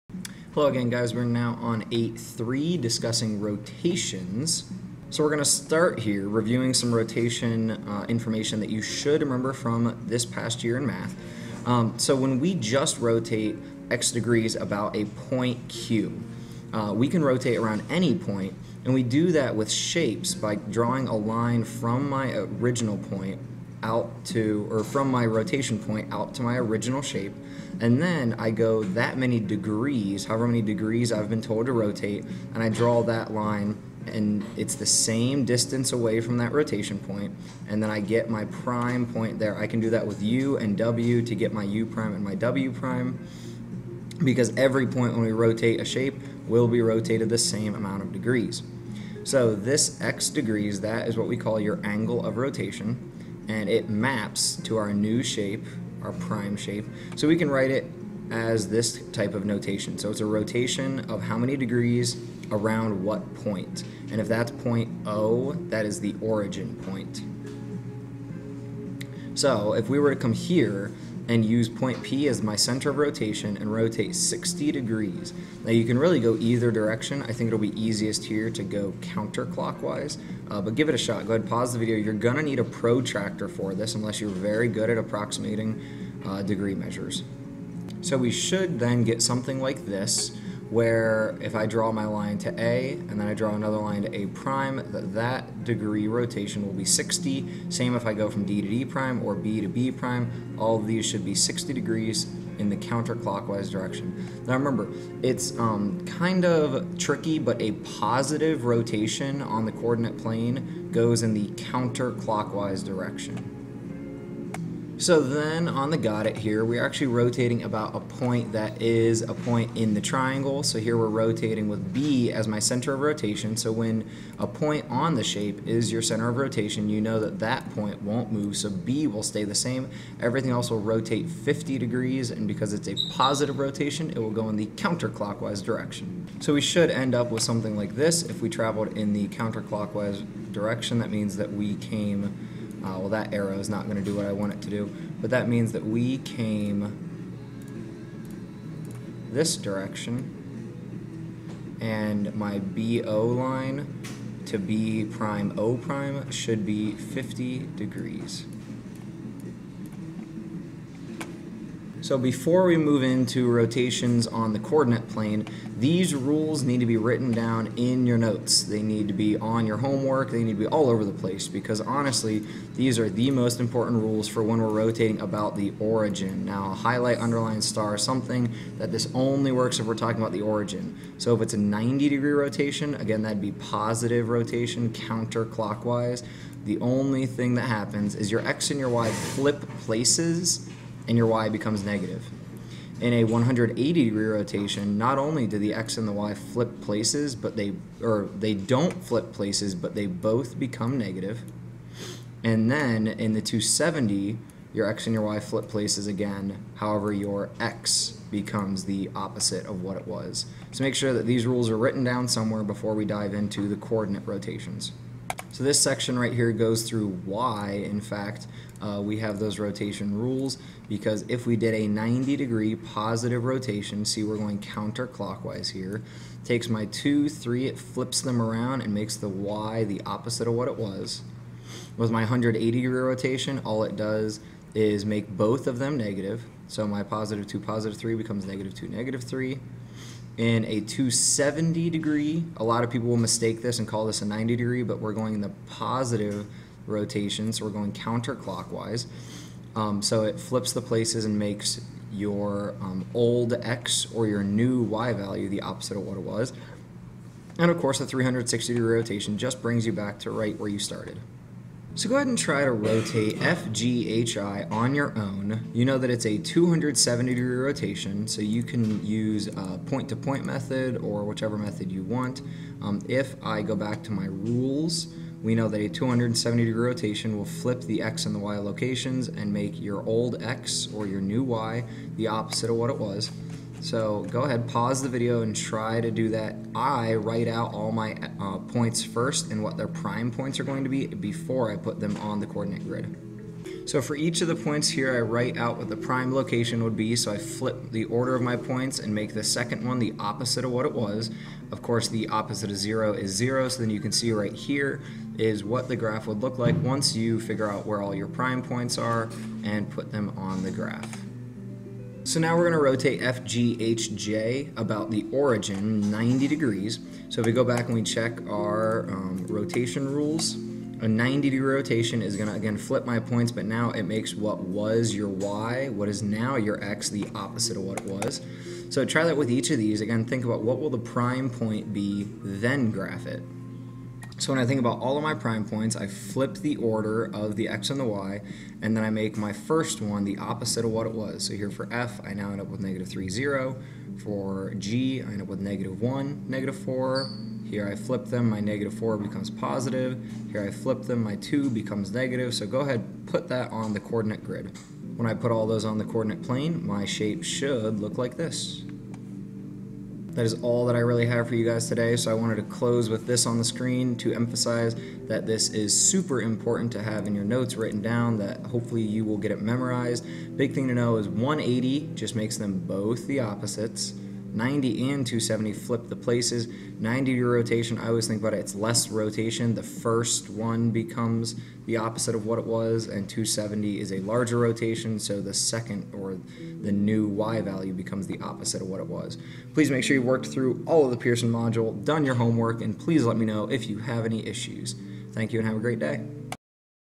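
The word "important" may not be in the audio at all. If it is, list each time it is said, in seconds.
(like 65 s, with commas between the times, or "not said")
173 s, 366 s.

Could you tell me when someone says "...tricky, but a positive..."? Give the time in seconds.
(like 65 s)
106 s.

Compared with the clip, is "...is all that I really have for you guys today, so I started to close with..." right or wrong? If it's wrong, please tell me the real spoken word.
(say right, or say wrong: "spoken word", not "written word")
wrong: "wanted", not "started".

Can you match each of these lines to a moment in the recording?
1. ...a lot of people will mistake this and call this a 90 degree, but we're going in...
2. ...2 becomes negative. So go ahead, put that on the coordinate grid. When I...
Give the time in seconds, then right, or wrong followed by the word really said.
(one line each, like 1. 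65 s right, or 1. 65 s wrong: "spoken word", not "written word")
1. 242 s right
2. 351 s right.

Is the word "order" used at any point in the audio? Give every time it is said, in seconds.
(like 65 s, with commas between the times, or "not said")
298 s, 336 s.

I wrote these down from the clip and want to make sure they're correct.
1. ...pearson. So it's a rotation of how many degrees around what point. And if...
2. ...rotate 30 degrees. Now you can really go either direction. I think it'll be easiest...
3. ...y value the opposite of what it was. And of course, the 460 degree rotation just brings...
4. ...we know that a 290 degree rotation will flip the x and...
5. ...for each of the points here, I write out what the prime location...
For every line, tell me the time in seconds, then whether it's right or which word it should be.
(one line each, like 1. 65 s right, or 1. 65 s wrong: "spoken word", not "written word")
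1. 59 s wrong: "notation", not "pearson"
2. 73 s wrong: "60", not "30"
3. 254 s wrong: "360", not "460"
4. 275 s wrong: "270", not "290"
5. 294 s right.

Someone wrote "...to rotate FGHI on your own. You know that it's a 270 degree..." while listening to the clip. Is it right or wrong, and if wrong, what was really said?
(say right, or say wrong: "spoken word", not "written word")
right.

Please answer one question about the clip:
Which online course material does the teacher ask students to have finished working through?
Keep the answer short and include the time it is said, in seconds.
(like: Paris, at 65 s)
Pearson module, at 391 s.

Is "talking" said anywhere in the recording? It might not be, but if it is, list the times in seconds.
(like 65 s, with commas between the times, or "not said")
179 s.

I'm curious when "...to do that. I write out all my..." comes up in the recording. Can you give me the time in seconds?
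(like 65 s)
286 s.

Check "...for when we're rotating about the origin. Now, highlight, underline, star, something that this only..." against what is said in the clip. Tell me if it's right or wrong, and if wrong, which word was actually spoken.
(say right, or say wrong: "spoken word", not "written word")
right.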